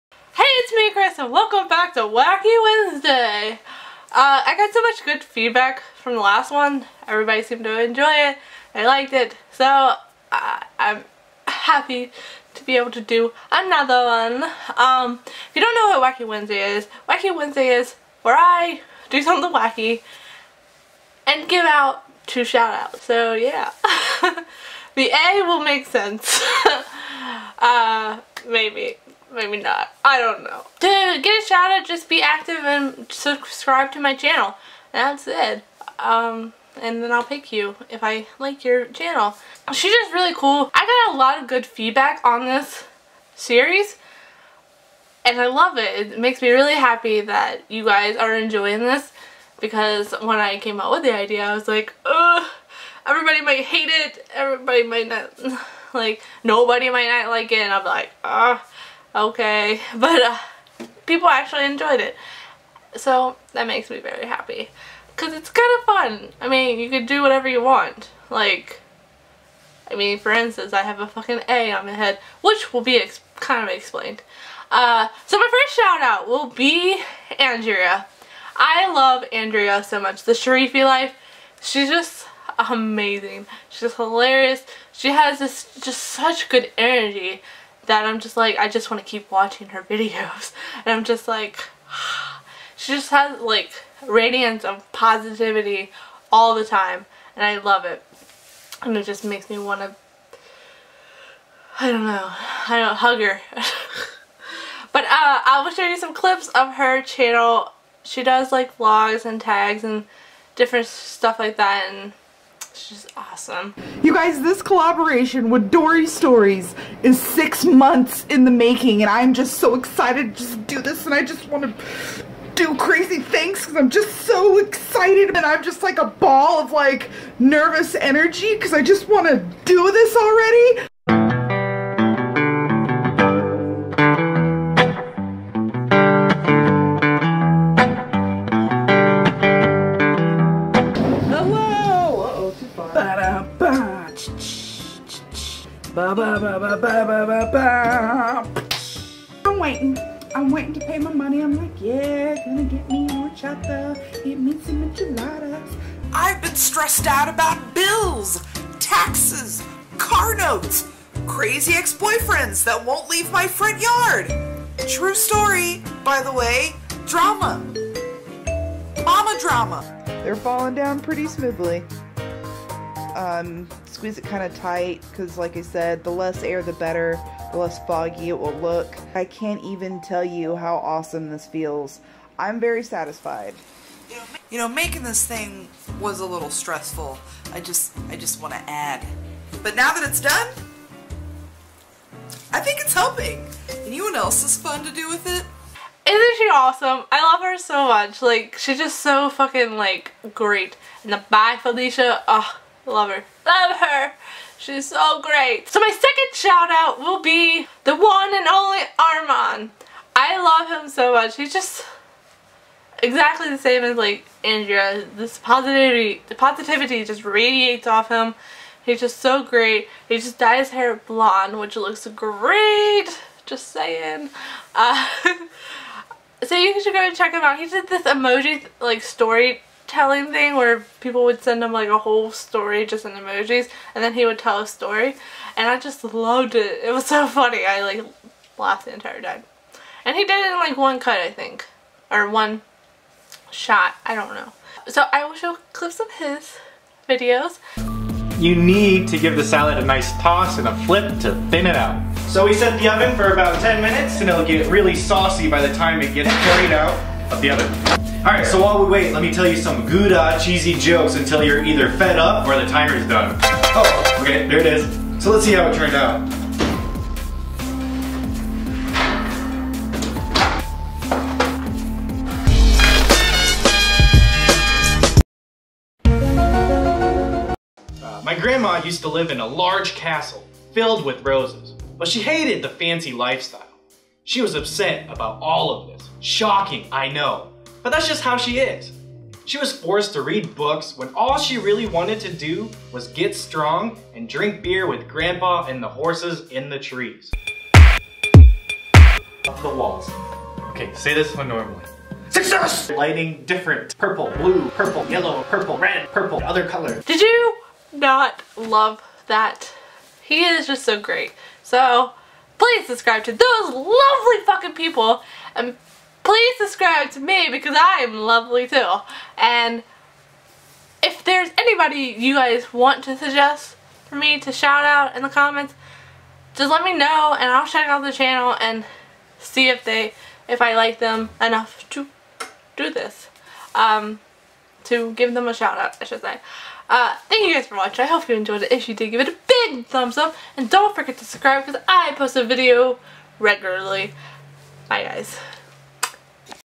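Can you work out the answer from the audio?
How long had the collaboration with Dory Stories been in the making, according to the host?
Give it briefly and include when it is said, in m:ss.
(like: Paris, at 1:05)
6 months, at 1:57.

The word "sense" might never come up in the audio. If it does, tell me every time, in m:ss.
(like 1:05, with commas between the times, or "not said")
0:25.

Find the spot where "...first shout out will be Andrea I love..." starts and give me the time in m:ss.
1:15.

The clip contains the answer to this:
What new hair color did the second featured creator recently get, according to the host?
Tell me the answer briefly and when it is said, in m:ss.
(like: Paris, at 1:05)
Blonde, at 3:40.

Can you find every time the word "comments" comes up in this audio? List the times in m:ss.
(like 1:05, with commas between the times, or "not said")
5:25.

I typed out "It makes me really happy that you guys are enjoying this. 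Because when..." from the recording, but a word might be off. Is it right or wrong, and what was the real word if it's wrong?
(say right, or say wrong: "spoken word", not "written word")
right.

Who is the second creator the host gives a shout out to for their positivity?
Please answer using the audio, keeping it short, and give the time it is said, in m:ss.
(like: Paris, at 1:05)
Armin, at 3:28.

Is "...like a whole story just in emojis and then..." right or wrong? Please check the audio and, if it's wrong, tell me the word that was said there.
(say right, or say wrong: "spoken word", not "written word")
right.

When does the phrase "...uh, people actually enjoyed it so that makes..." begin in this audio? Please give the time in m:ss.
1:00.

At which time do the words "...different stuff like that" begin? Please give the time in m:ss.
1:50.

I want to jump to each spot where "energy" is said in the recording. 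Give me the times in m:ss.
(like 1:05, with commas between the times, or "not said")
1:26, 2:07.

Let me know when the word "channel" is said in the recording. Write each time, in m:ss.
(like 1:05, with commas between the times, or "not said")
0:34, 0:38, 1:47, 5:28.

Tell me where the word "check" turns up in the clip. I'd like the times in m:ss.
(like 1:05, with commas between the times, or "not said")
3:47, 5:27.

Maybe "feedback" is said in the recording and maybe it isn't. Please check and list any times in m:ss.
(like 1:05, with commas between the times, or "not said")
0:05, 0:41.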